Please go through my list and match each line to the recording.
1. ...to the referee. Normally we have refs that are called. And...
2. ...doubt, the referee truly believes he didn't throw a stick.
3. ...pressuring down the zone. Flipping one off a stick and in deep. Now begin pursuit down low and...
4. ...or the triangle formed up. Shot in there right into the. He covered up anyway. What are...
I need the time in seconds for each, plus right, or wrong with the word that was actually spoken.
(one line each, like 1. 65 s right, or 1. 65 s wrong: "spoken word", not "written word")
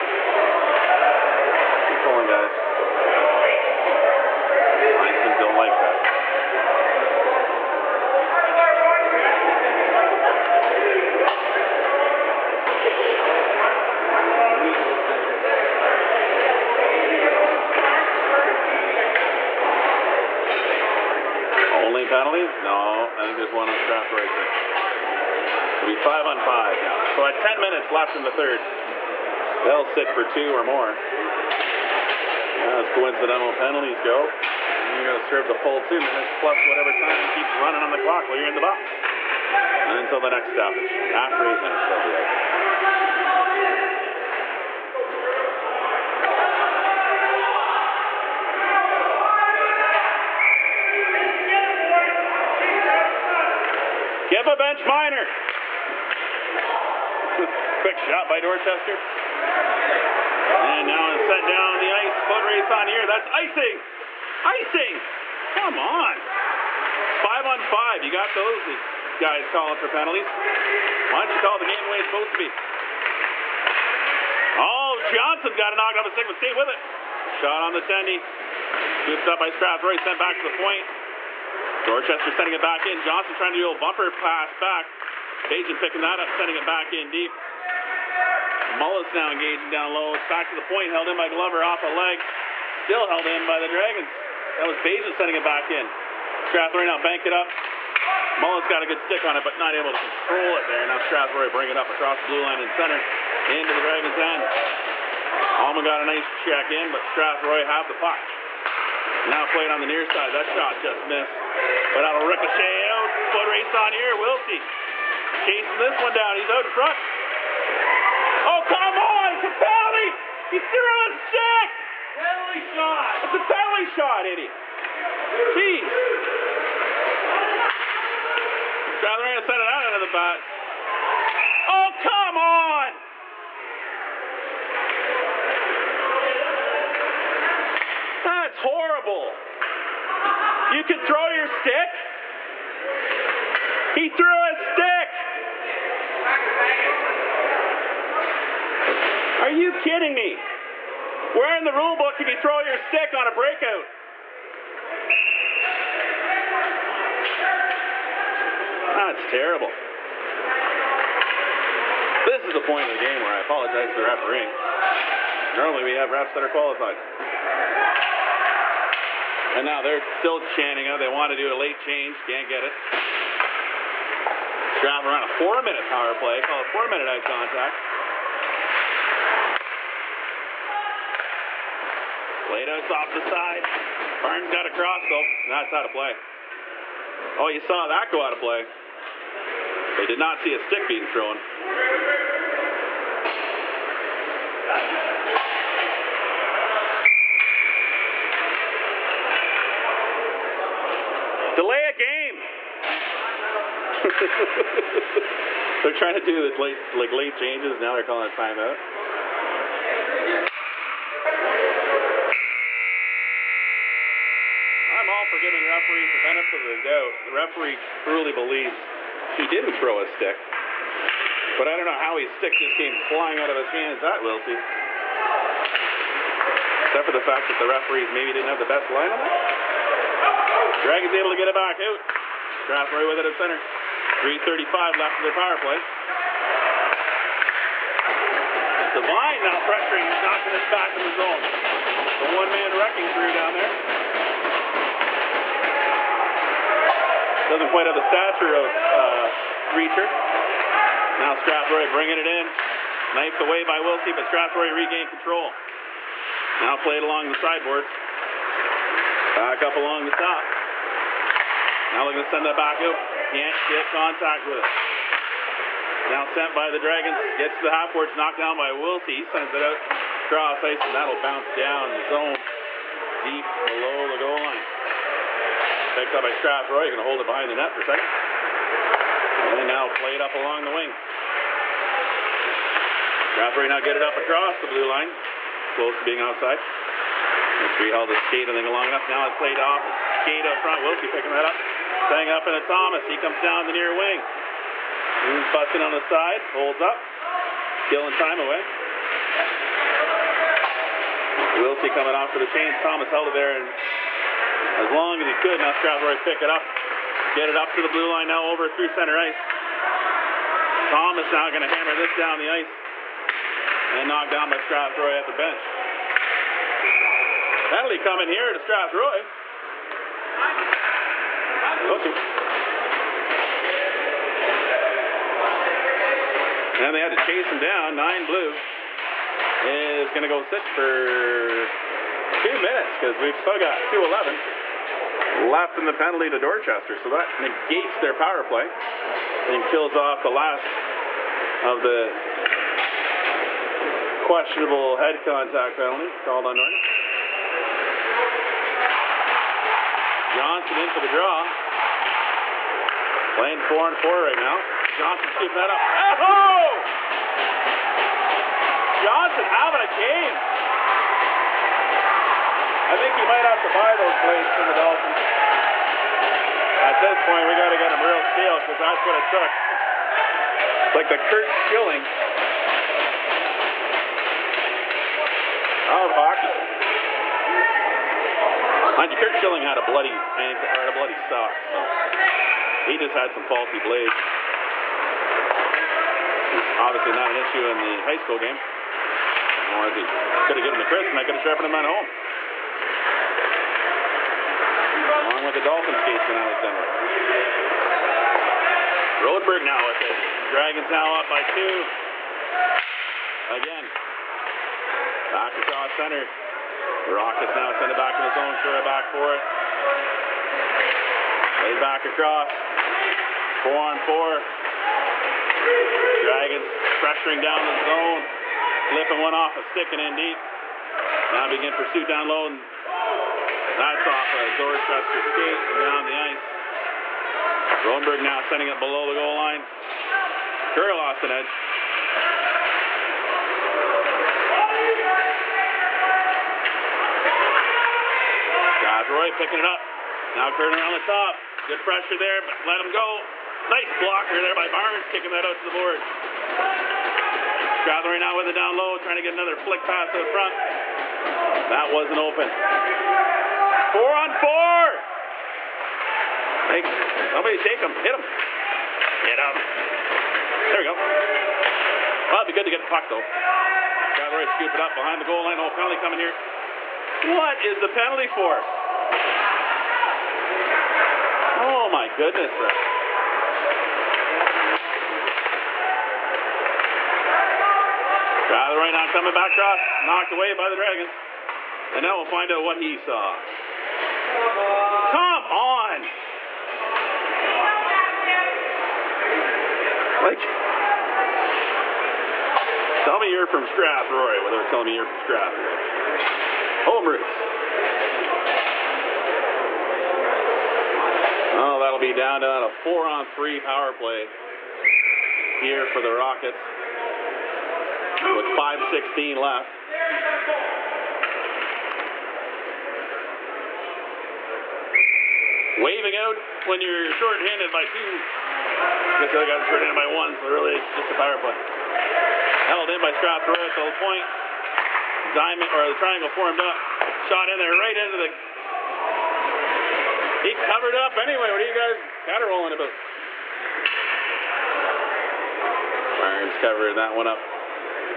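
1. 163 s wrong: "qualified", not "called"
2. 216 s right
3. 417 s right
4. 525 s right.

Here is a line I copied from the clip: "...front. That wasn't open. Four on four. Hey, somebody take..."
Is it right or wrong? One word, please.
right.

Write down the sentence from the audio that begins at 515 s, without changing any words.
waving out when you're short-handed by two.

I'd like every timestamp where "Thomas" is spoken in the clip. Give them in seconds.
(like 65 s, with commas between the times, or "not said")
292 s, 302 s, 310 s.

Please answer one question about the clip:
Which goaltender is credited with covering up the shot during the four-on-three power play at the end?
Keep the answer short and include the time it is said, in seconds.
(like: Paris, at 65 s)
Irons, at 536 s.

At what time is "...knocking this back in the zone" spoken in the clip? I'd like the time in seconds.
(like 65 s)
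240 s.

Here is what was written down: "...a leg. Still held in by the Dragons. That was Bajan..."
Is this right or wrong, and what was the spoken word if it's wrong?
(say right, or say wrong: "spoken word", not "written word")
right.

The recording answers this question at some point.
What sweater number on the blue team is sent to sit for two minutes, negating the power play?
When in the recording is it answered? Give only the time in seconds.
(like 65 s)
327 s.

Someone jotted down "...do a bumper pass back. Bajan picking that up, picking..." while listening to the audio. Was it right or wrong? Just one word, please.
wrong.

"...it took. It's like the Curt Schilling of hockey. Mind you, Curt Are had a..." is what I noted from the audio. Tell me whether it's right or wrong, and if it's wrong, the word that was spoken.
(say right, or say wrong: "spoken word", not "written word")
wrong: "Schilling", not "Are".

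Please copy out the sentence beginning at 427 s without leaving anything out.
Rodenberg now sending it below the goal line.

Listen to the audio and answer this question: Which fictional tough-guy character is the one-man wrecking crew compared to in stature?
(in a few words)
Reacher.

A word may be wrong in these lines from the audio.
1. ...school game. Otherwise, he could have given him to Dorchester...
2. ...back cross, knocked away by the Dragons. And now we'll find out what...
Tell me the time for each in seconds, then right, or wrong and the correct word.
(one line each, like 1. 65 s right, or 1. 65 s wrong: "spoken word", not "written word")
1. 388 s wrong: "Chris", not "Dorchester"
2. 479 s right.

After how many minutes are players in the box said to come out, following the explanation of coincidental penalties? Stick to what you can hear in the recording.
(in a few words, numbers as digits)
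8.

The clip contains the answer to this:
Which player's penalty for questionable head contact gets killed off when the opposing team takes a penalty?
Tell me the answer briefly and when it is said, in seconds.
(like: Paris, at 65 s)
Norton, at 346 s.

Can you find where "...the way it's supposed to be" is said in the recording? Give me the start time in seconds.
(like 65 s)
71 s.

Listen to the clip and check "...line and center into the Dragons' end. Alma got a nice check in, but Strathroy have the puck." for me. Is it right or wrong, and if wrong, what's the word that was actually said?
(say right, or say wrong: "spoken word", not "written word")
right.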